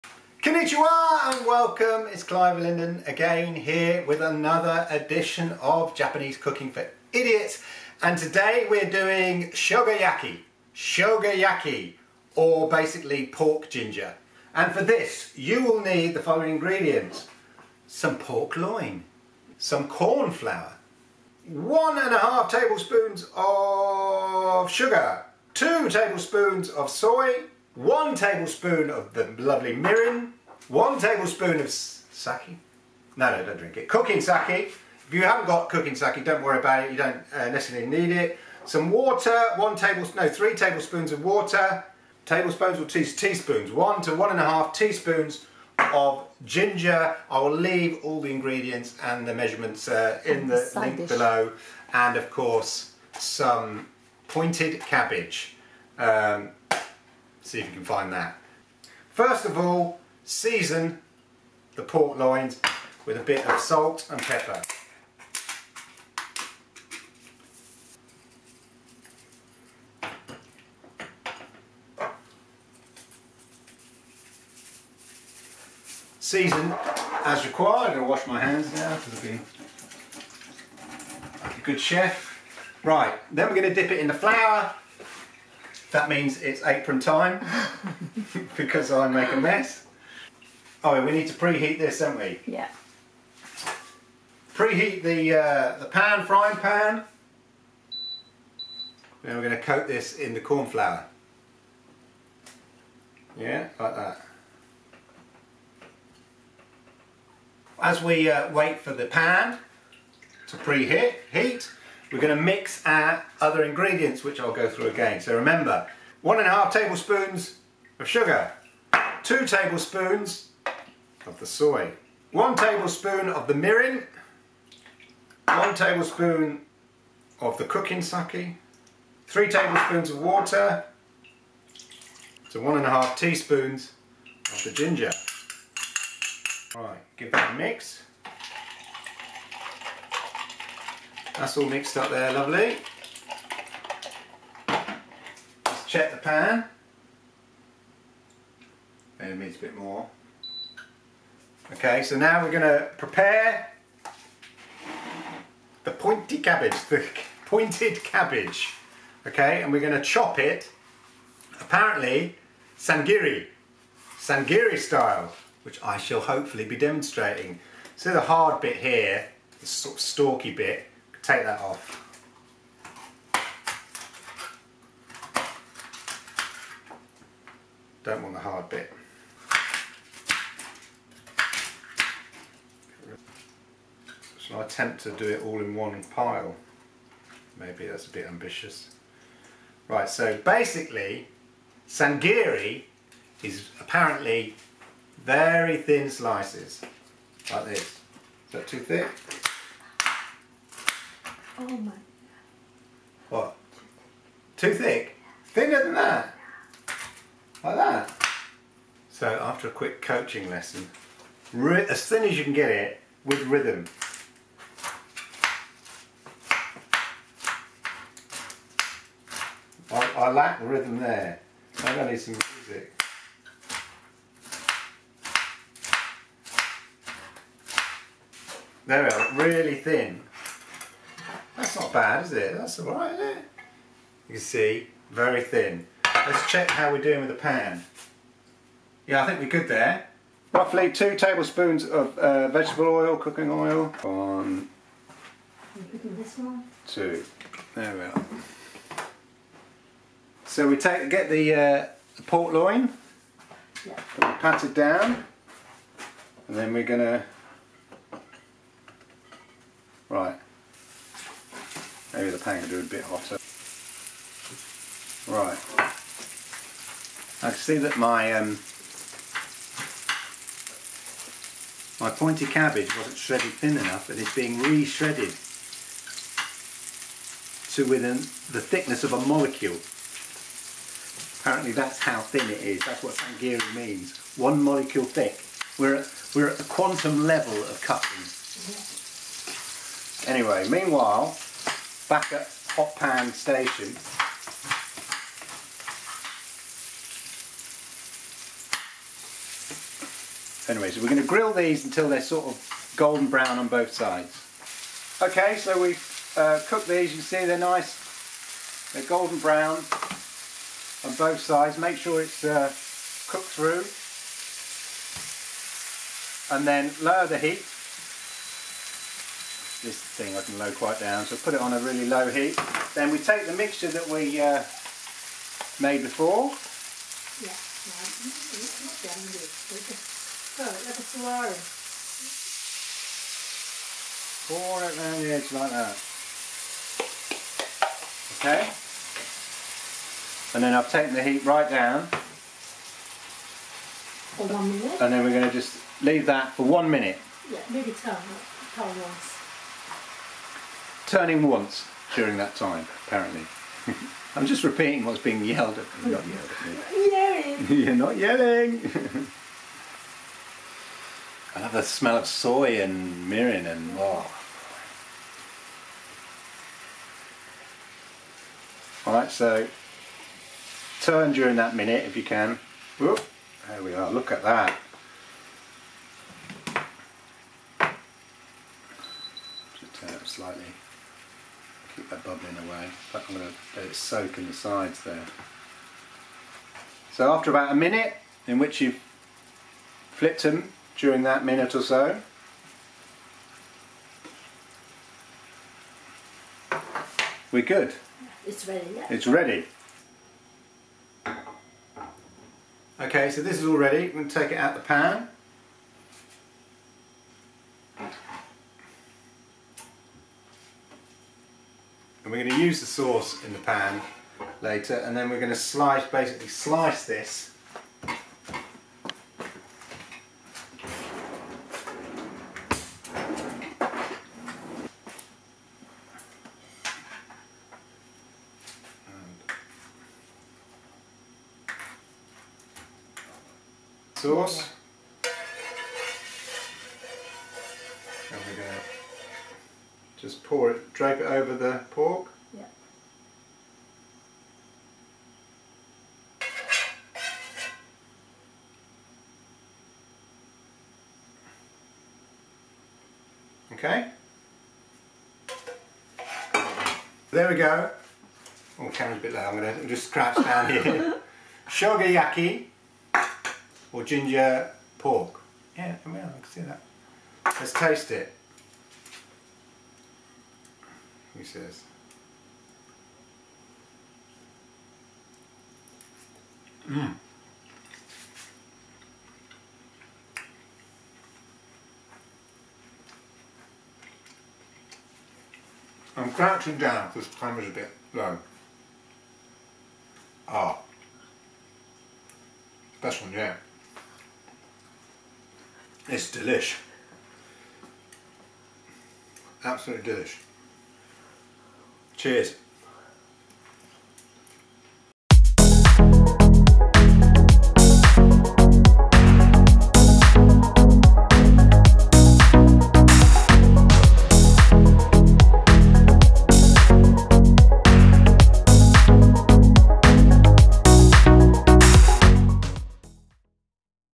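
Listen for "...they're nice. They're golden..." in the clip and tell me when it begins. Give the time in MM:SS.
05:07.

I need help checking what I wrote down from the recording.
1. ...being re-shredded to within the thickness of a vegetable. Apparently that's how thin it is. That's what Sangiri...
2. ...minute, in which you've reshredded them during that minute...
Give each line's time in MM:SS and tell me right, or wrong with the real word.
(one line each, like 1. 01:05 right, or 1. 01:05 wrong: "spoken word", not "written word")
1. 04:34 wrong: "molecule", not "vegetable"
2. 06:27 wrong: "flipped", not "reshredded".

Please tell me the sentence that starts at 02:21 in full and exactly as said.
That's all mixed up there, lovely.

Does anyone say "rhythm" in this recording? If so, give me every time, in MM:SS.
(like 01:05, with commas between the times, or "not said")
03:33, 03:40.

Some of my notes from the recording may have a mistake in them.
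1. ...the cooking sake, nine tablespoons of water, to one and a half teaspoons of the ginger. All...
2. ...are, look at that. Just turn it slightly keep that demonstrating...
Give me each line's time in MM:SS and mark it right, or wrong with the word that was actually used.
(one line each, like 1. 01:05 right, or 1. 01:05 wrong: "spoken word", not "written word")
1. 02:07 wrong: "three", not "nine"
2. 06:13 wrong: "bubbling", not "demonstrating".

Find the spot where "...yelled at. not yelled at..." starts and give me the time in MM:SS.
05:55.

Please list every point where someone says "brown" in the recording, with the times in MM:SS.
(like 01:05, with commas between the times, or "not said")
05:03, 05:09.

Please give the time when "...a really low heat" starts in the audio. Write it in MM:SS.
05:21.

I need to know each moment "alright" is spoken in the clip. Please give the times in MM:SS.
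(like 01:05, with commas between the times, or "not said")
03:52, 06:09.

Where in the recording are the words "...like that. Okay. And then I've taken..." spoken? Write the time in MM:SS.
05:35.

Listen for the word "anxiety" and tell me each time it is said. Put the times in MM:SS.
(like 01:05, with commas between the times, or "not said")
not said.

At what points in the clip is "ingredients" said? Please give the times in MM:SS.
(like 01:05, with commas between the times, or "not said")
00:16, 00:48, 01:53.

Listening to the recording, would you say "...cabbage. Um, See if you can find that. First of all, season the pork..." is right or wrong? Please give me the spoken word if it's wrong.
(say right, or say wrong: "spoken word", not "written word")
right.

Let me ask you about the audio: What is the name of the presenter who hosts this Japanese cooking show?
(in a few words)
Clive Illenden.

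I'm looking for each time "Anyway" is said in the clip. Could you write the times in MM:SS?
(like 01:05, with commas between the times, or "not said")
04:50, 05:00.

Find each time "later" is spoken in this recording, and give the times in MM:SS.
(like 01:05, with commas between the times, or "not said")
06:54.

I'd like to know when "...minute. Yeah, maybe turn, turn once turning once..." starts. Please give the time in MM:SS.
05:46.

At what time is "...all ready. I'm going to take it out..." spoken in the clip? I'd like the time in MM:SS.
06:43.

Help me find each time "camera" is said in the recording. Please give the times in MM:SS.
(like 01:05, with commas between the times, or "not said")
07:38, 08:07.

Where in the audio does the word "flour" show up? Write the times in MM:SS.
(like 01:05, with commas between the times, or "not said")
00:20, 01:24, 01:40.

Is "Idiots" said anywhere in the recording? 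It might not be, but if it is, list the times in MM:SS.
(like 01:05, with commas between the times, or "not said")
00:07.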